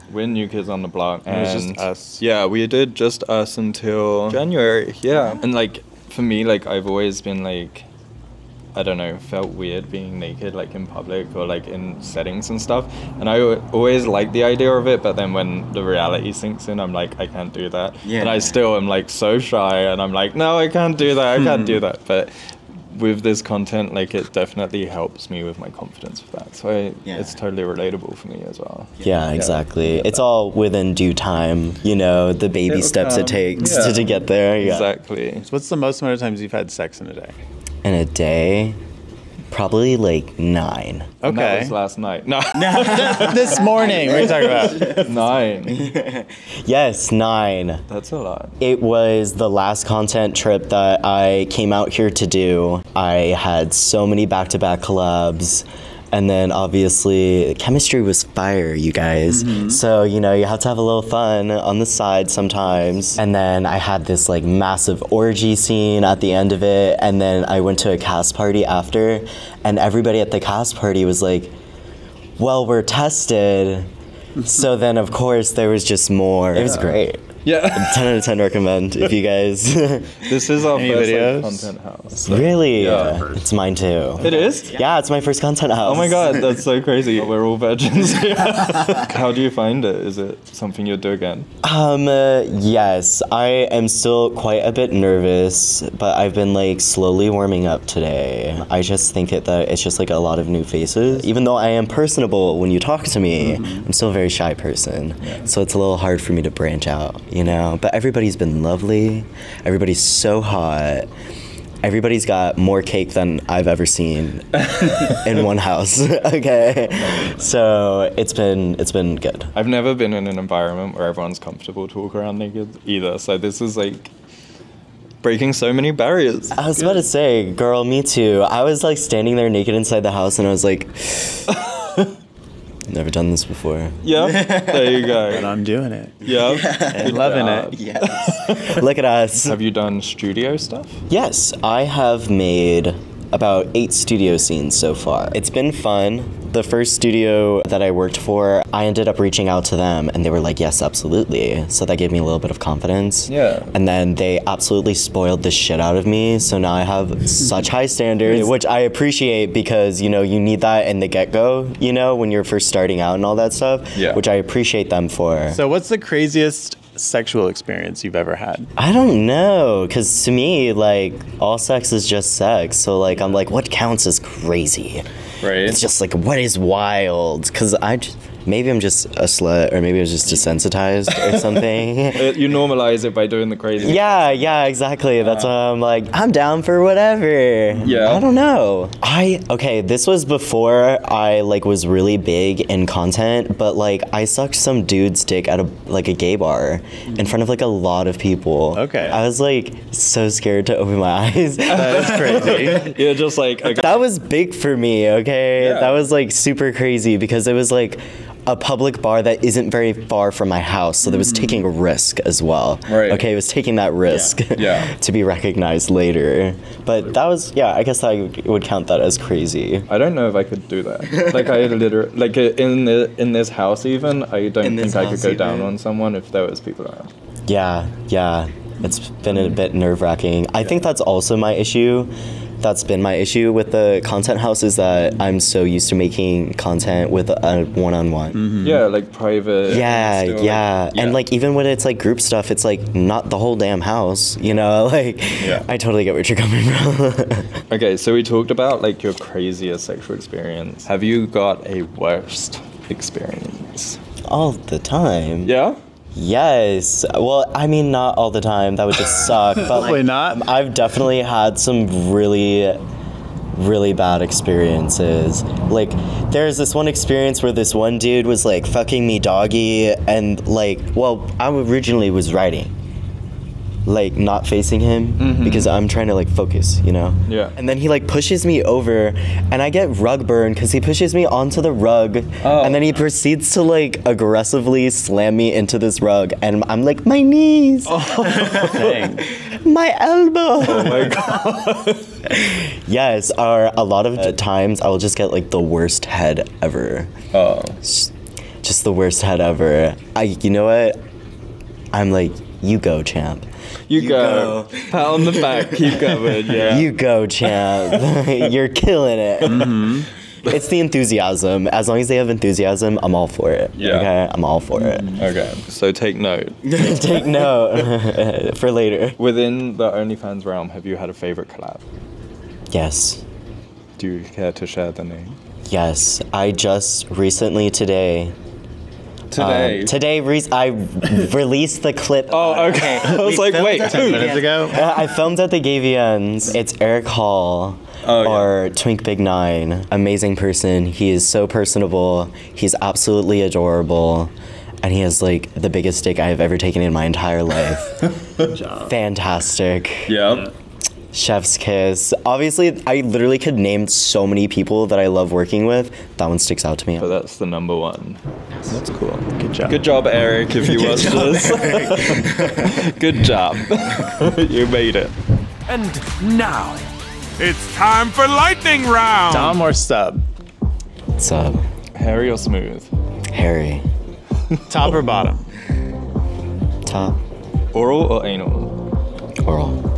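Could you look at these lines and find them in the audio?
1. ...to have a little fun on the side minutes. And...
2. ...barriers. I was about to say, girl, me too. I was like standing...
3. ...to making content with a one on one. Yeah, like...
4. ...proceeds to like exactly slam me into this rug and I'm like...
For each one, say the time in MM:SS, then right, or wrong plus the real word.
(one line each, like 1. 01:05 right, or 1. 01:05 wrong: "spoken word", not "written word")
1. 01:00 wrong: "sometimes", not "minutes"
2. 02:05 right
3. 03:55 right
4. 04:42 wrong: "aggressively", not "exactly".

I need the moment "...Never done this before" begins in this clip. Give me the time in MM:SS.
02:12.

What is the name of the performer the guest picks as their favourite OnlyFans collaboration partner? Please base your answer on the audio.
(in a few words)
Eric Hall.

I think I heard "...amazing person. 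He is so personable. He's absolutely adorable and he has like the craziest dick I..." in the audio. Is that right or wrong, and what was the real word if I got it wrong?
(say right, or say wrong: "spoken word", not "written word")
wrong: "biggest", not "craziest".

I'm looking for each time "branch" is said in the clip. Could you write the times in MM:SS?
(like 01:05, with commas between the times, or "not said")
01:46.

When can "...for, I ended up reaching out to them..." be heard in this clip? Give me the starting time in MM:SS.
02:28.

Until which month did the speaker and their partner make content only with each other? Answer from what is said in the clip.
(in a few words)
January.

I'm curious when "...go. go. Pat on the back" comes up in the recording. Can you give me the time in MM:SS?
05:04.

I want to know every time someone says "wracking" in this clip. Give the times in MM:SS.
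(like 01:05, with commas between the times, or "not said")
03:50.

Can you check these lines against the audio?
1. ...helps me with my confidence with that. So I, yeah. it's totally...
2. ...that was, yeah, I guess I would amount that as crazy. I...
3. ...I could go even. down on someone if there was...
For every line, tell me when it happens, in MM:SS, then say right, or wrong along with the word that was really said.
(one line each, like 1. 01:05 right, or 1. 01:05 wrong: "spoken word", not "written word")
1. 00:24 right
2. 03:37 wrong: "count", not "amount"
3. 03:44 right.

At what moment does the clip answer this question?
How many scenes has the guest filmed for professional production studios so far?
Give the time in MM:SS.
02:23.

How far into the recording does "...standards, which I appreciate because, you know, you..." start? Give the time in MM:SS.
02:37.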